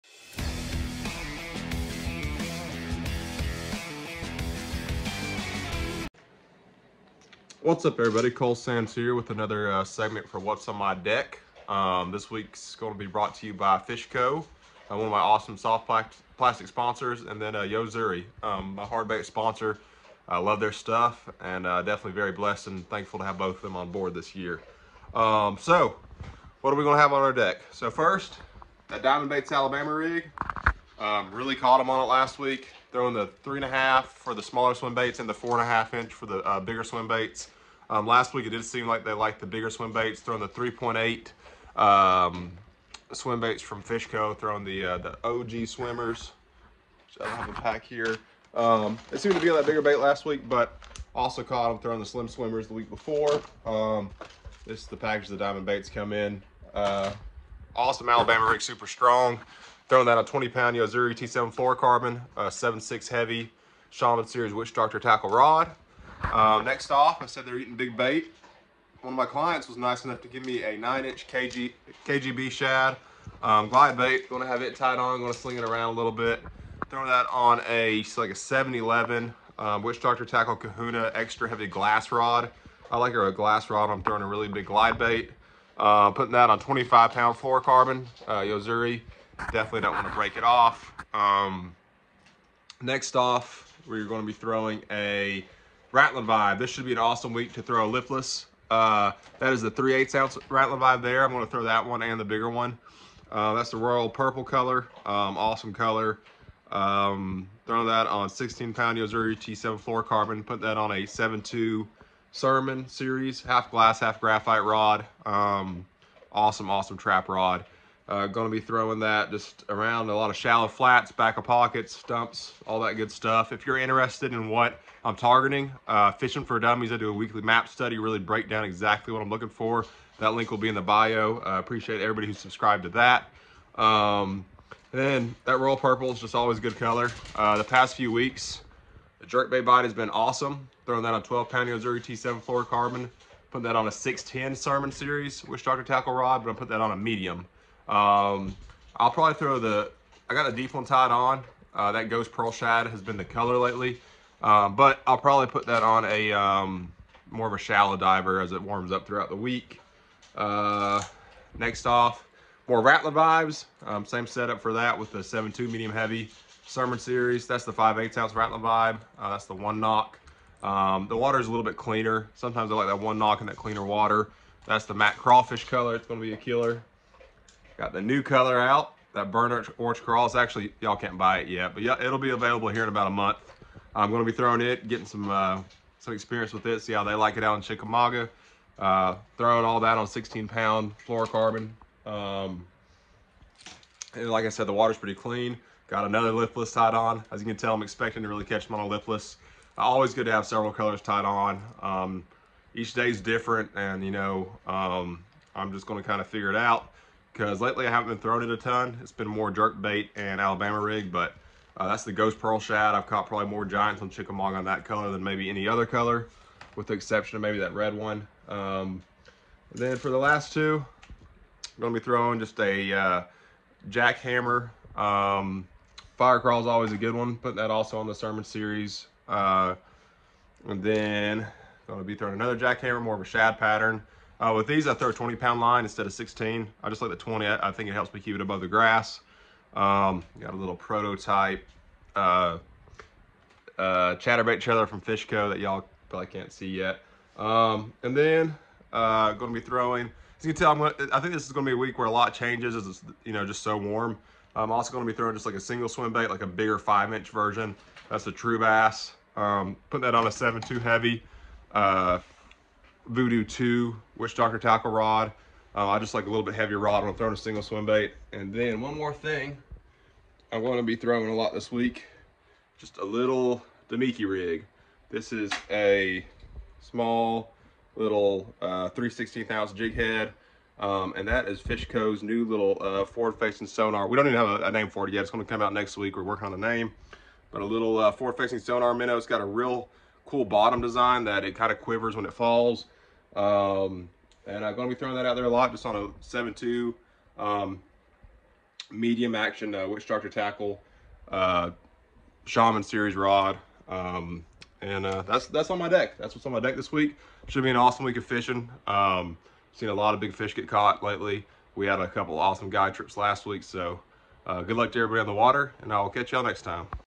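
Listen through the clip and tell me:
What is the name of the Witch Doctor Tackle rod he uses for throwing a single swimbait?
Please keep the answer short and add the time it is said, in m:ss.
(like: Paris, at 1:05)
Voodoo 2, at 4:23.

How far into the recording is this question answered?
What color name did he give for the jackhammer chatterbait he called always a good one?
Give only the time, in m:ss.
3:46.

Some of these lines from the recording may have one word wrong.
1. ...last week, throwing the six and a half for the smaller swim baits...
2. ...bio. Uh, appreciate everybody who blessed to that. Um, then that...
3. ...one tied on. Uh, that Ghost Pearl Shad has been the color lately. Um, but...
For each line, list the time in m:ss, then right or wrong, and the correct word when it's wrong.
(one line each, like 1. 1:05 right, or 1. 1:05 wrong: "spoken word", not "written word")
1. 0:32 wrong: "three", not "six"
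2. 2:10 wrong: "subscribed", not "blessed"
3. 2:30 right.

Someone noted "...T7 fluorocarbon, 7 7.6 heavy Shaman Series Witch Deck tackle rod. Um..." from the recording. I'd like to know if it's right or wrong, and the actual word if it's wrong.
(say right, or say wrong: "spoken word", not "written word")
wrong: "Doctor", not "Deck".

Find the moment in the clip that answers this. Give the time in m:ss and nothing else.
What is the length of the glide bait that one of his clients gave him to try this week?
1:10.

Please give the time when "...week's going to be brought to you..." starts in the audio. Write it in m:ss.
0:12.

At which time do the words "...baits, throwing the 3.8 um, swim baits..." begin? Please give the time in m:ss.
0:39.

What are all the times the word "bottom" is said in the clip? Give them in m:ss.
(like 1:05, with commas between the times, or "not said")
4:50.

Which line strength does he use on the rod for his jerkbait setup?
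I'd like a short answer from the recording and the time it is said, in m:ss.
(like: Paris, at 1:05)
12 pound, at 2:21.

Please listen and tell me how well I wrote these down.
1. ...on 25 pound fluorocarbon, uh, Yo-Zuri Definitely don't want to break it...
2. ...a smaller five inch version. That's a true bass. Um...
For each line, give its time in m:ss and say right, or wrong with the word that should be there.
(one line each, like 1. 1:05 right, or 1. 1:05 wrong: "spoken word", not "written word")
1. 1:26 right
2. 4:16 wrong: "bigger", not "smaller".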